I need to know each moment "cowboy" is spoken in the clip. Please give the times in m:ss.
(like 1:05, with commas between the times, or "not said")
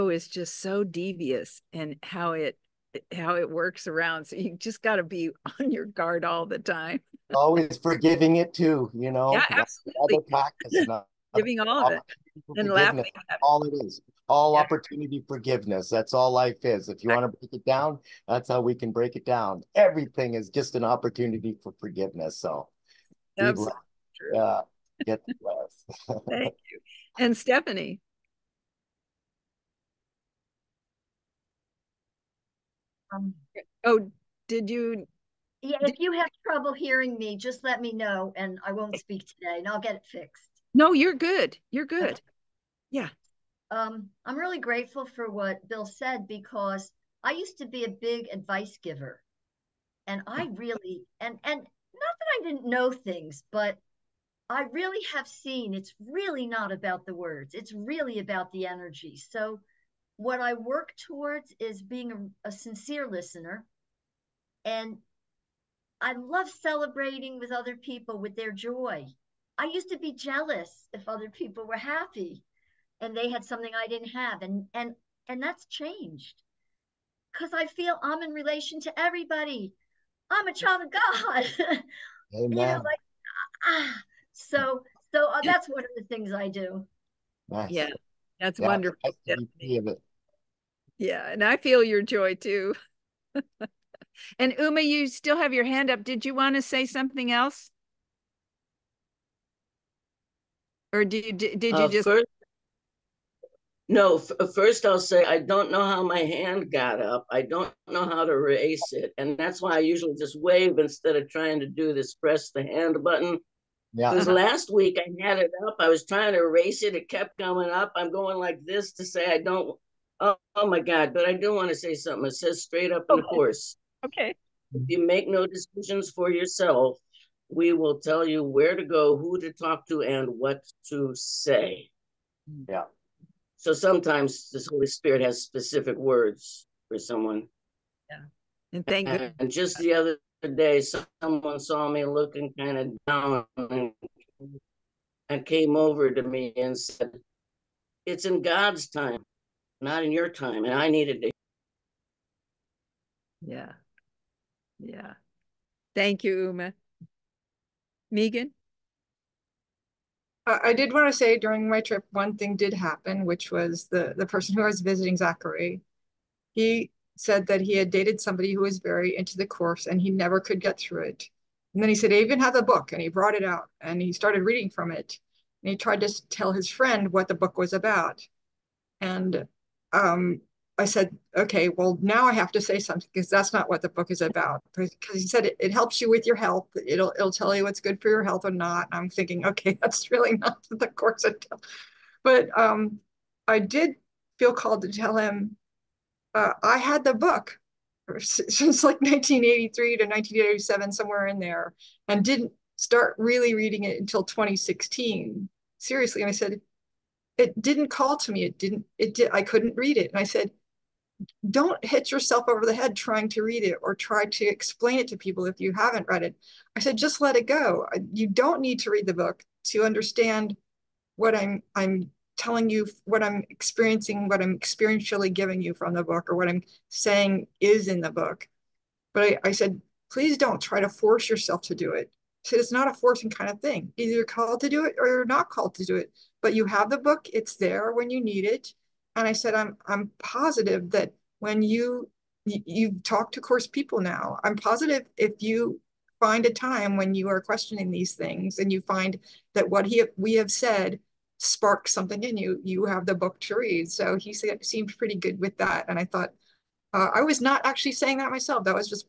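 not said.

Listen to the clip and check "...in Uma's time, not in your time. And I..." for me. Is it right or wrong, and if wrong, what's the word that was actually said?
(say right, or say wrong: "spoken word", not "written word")
wrong: "God", not "Uma".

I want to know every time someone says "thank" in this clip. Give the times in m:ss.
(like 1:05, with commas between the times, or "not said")
0:26, 2:18, 2:35.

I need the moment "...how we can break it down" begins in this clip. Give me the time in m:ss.
0:18.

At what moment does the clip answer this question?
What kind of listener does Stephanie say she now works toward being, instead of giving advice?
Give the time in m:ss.
1:02.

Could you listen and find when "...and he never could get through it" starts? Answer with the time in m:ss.
2:49.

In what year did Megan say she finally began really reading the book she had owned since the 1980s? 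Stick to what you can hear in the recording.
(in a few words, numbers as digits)
2016.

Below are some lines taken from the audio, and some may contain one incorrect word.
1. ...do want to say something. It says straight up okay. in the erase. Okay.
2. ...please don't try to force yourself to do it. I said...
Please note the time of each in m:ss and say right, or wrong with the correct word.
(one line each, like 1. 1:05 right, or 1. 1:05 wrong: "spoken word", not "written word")
1. 2:01 wrong: "course", not "erase"
2. 3:50 right.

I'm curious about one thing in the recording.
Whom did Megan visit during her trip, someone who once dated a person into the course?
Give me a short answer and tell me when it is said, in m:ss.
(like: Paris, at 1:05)
Zachary, at 2:45.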